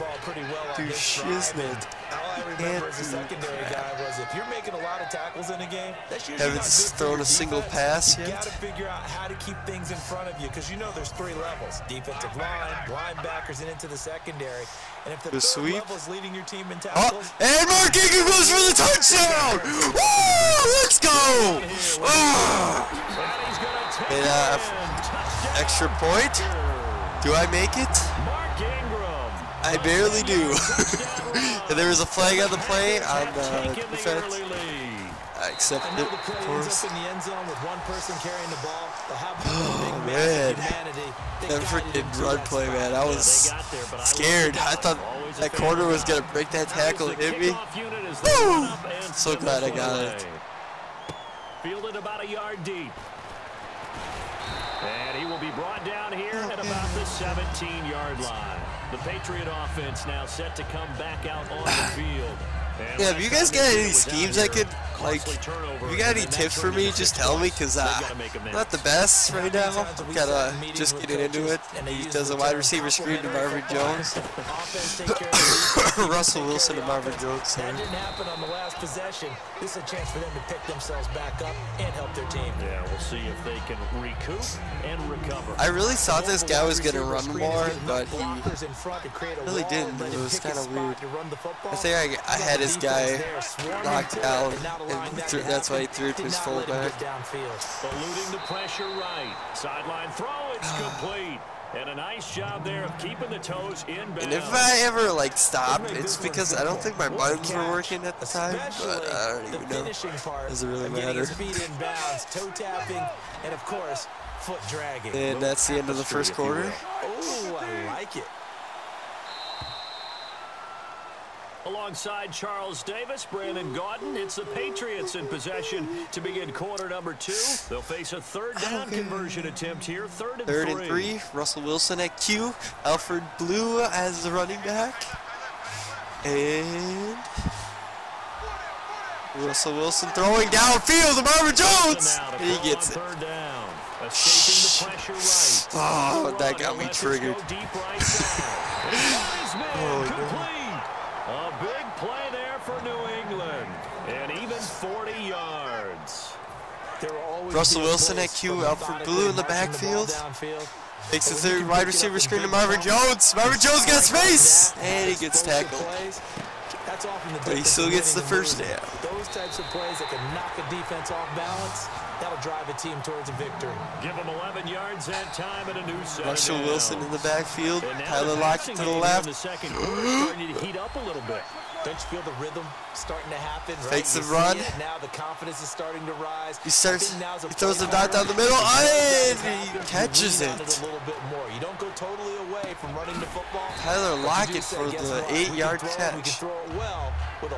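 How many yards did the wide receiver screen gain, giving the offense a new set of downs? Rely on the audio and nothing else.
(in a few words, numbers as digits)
11.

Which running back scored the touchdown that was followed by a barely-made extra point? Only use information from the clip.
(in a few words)
Mark Ingram.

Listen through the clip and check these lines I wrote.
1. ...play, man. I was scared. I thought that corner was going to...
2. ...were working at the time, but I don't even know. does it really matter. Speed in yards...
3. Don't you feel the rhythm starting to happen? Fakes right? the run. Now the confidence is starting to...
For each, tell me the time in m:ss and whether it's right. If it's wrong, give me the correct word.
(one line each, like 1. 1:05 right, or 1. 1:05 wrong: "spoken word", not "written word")
1. 0:42 right
2. 1:47 wrong: "bounds", not "yards"
3. 3:01 right.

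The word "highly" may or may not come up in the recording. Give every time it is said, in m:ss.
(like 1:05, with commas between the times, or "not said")
not said.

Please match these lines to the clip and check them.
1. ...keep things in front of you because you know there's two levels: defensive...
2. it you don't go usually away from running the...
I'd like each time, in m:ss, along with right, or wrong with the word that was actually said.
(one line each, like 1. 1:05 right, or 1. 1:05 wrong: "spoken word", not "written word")
1. 0:09 wrong: "three", not "two"
2. 3:10 wrong: "totally", not "usually".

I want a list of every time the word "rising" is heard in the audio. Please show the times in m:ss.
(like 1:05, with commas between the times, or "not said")
not said.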